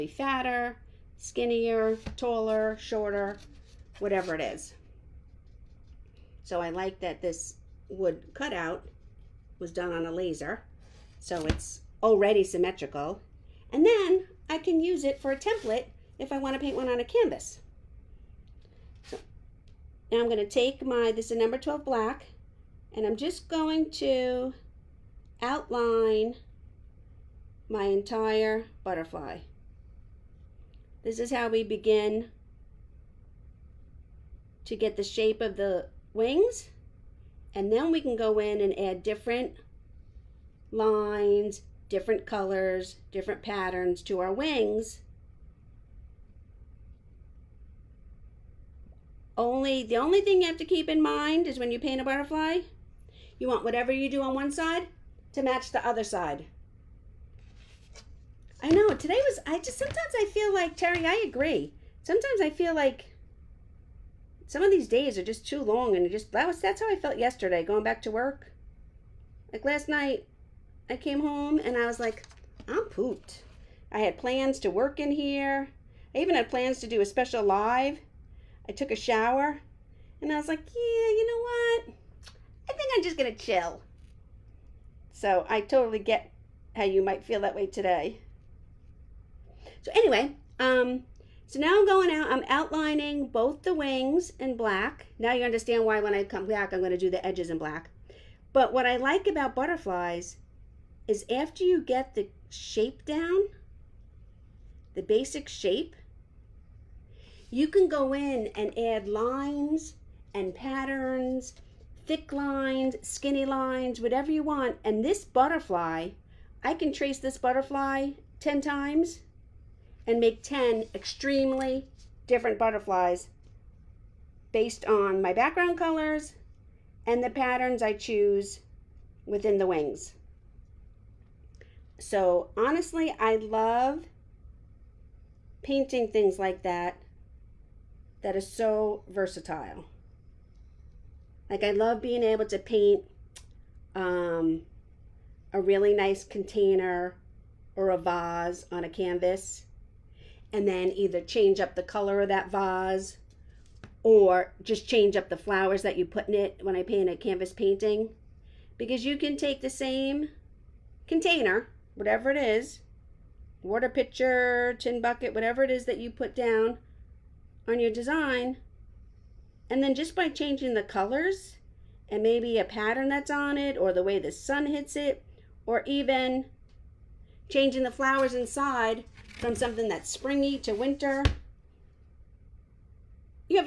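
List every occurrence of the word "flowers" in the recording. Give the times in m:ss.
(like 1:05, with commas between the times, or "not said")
2:35, 2:57.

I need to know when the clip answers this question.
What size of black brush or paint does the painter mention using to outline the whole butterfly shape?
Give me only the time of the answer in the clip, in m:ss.
0:21.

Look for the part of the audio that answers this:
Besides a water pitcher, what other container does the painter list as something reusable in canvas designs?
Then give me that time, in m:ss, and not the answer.
2:44.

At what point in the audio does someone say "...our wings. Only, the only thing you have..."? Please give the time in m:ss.
0:44.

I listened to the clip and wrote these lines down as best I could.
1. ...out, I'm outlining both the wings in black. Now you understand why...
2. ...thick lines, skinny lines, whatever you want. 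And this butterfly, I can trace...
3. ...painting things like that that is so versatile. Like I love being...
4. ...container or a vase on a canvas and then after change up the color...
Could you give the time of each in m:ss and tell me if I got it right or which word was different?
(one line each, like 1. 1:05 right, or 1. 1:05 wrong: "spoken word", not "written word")
1. 1:32 right
2. 1:52 right
3. 2:15 right
4. 2:26 wrong: "either", not "after".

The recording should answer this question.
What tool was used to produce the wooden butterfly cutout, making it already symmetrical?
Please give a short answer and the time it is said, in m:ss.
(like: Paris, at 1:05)
Laser, at 0:10.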